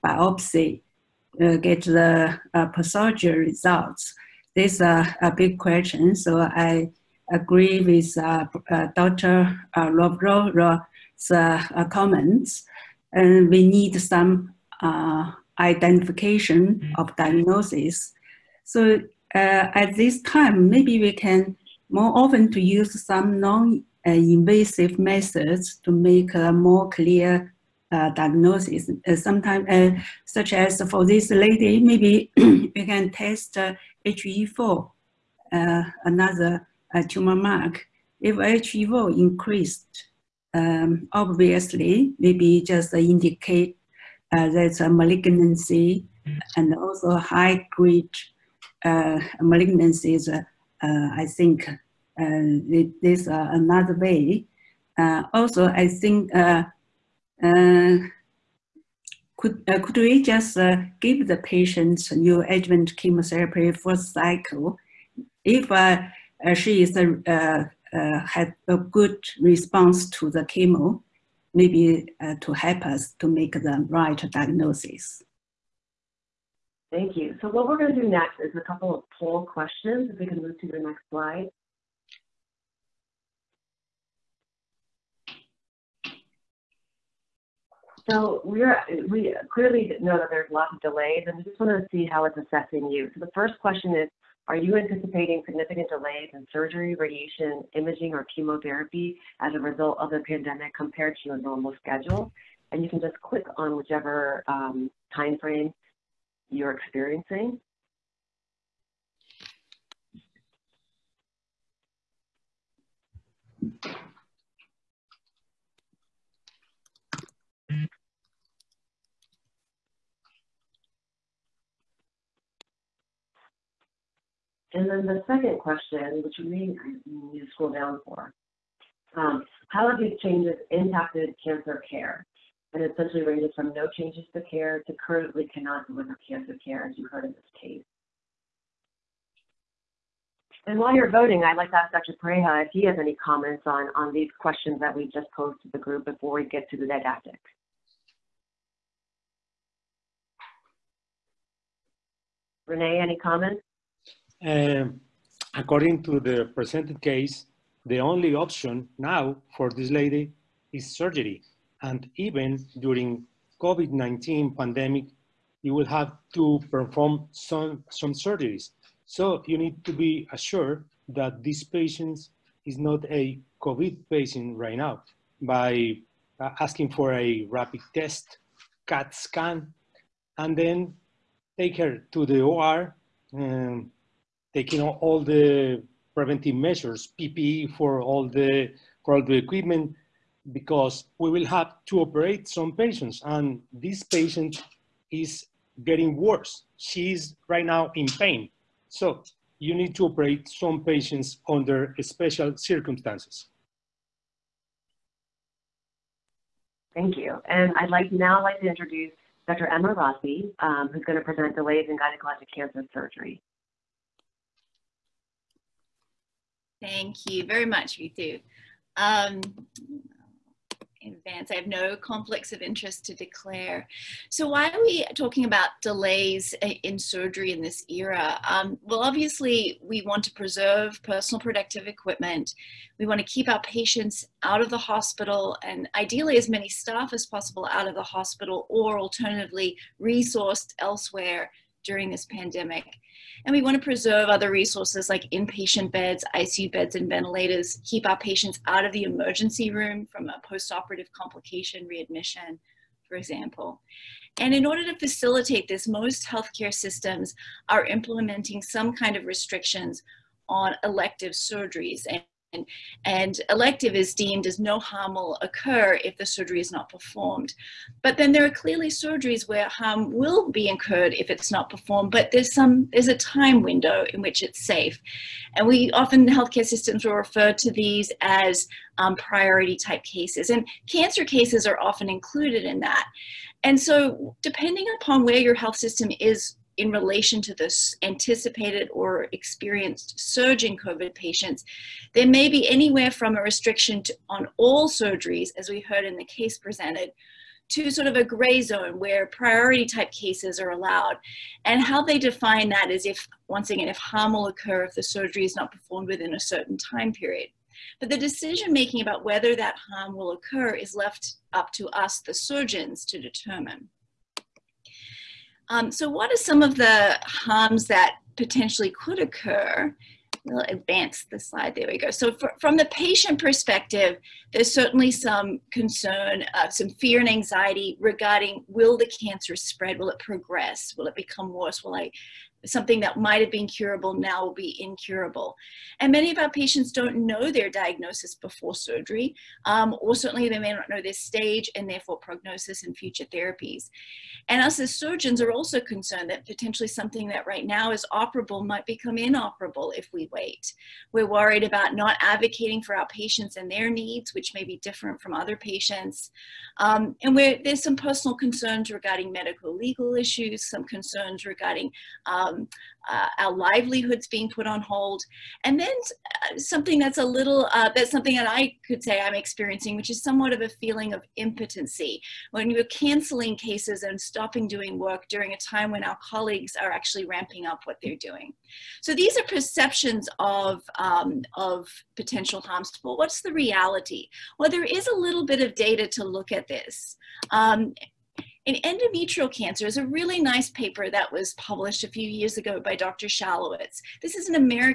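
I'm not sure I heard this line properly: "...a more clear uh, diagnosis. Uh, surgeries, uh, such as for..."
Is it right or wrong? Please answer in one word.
wrong.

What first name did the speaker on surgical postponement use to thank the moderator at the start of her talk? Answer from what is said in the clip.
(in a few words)
Ritu.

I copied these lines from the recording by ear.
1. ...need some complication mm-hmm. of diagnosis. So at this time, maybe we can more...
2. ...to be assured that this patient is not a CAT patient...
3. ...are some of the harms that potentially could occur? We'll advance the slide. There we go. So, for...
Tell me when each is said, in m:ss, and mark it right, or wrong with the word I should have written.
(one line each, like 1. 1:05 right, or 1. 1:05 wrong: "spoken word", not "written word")
1. 0:13 wrong: "identification", not "complication"
2. 2:49 wrong: "COVID", not "CAT"
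3. 5:16 right.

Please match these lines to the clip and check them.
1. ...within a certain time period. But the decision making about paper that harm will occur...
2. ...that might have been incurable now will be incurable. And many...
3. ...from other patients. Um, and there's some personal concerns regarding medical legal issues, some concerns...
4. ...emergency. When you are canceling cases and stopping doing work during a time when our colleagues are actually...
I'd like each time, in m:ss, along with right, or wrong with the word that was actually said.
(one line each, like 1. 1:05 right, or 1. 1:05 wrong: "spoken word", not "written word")
1. 5:06 wrong: "whether", not "paper"
2. 5:32 wrong: "curable", not "incurable"
3. 5:55 right
4. 6:11 wrong: "impotency", not "emergency".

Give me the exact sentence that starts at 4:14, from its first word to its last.
And in order to facilitate this, most healthcare systems are implementing some kind of restrictions on elective surgeries.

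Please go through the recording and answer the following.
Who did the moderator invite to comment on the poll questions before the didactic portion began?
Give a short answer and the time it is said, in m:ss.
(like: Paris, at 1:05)
Dr. Pareja, at 2:21.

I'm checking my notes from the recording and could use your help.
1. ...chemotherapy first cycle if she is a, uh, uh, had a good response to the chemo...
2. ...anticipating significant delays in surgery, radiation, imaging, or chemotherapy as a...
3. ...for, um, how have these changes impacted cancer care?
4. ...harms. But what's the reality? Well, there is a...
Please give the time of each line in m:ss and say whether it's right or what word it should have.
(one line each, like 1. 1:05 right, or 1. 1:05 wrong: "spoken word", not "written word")
1. 1:02 right
2. 1:34 right
3. 2:08 right
4. 6:22 right.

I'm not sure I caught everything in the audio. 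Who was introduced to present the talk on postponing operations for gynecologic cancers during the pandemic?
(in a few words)
Dr. Emma Rossi.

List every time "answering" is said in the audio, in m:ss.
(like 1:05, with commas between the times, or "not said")
not said.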